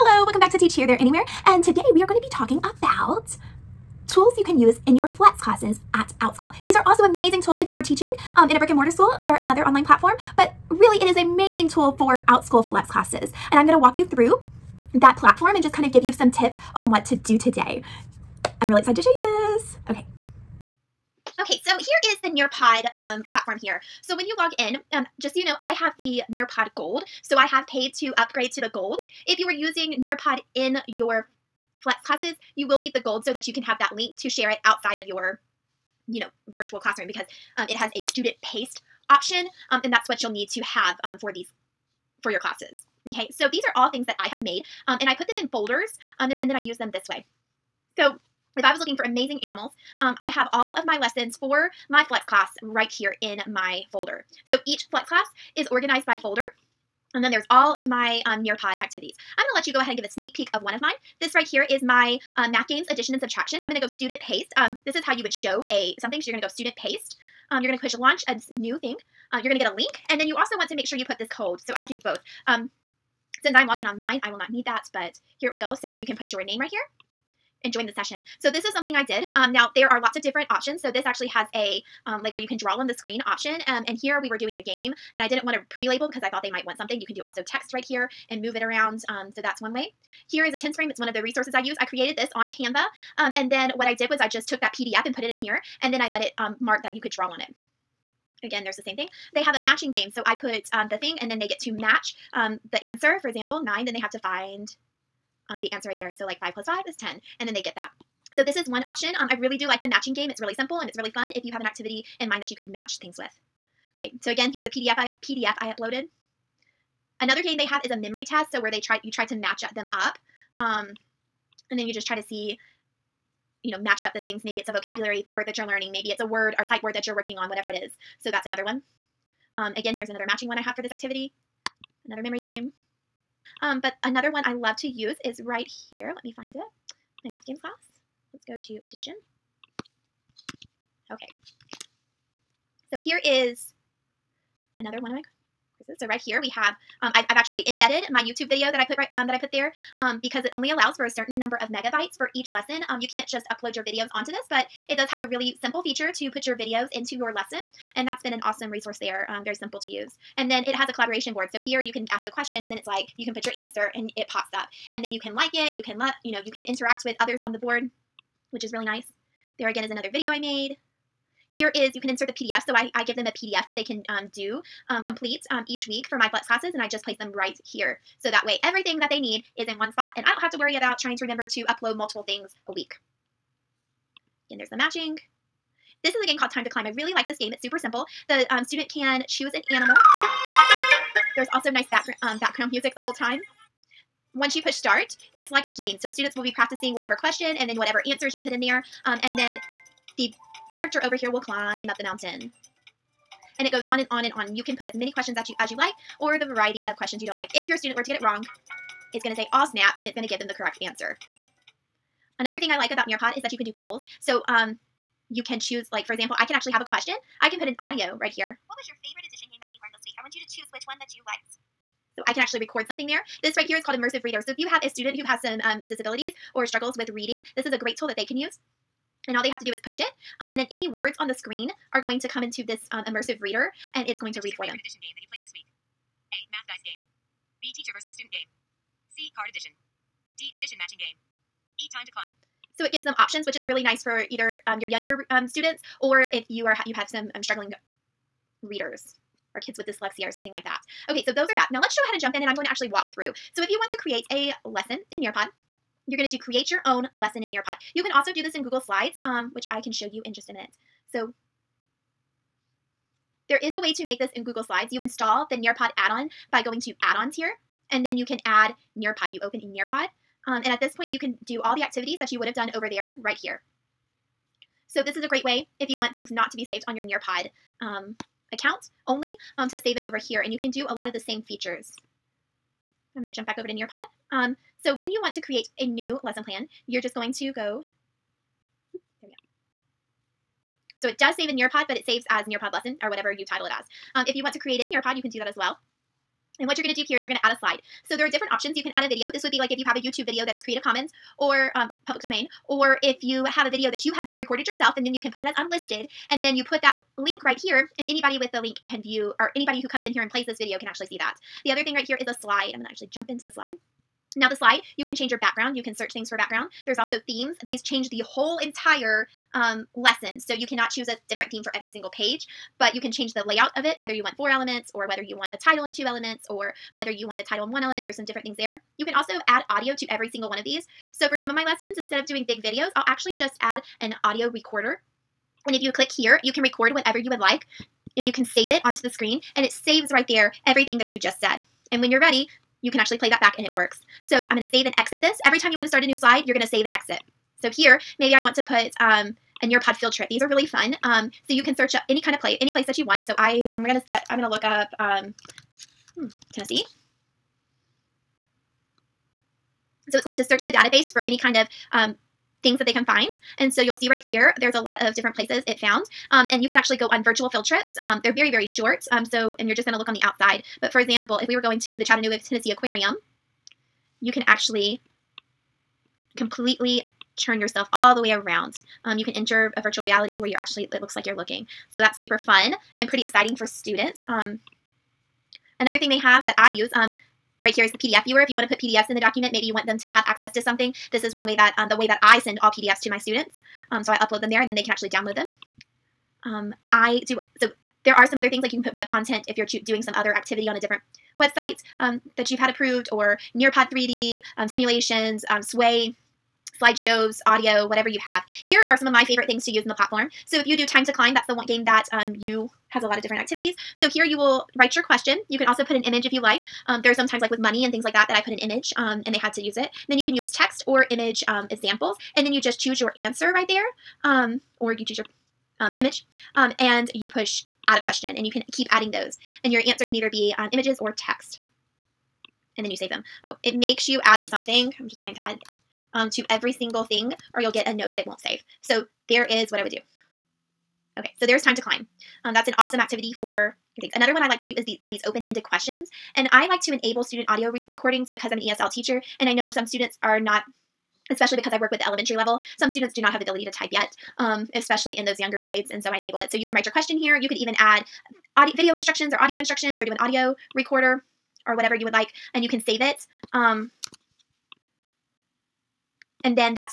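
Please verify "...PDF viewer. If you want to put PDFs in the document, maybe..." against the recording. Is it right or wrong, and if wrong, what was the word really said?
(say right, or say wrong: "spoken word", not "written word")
right.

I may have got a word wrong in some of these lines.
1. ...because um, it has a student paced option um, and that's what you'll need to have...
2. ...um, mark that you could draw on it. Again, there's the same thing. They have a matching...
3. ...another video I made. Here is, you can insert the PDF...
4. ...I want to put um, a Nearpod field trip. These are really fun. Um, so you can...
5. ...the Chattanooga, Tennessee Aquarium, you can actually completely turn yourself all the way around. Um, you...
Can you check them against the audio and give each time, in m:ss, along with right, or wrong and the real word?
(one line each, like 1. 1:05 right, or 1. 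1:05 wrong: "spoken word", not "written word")
1. 0:37 right
2. 1:36 right
3. 2:49 right
4. 5:48 right
5. 6:11 right.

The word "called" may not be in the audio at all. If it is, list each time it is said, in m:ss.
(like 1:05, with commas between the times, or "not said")
3:06, 3:43.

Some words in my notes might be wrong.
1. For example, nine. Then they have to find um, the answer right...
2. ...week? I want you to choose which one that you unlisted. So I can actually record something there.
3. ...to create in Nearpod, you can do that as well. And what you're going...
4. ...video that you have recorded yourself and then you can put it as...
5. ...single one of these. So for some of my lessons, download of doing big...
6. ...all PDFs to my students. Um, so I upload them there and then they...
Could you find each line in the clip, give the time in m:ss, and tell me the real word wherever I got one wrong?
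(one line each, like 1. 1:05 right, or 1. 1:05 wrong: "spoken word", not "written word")
1. 1:43 right
2. 3:40 wrong: "liked", not "unlisted"
3. 4:54 right
4. 5:03 right
5. 5:30 wrong: "instead", not "download"
6. 6:32 right.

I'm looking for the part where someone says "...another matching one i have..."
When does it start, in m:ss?
2:10.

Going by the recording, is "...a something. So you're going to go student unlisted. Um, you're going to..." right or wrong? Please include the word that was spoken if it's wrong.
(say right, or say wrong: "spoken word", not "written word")
wrong: "paced", not "unlisted".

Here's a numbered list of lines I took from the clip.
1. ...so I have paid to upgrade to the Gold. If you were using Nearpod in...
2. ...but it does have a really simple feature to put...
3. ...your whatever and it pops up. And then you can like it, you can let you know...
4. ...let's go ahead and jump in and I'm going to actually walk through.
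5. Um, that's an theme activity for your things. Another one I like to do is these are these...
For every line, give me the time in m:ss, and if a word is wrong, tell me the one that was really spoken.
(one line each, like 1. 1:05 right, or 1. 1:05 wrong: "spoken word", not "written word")
1. 0:27 right
2. 2:34 right
3. 2:43 wrong: "answer", not "whatever"
4. 4:11 right
5. 7:22 wrong: "awesome", not "theme".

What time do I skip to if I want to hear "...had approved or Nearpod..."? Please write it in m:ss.
6:42.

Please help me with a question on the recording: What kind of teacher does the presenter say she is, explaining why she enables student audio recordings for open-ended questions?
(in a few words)
ESL teacher.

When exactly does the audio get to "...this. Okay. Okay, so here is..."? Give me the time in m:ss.
0:19.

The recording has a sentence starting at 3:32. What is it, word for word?
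Another thing I like about Nearpod is that you can do polls.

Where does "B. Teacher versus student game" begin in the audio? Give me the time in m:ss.
3:57.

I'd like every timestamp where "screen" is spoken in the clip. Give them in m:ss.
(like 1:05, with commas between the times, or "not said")
1:22, 3:51, 5:39.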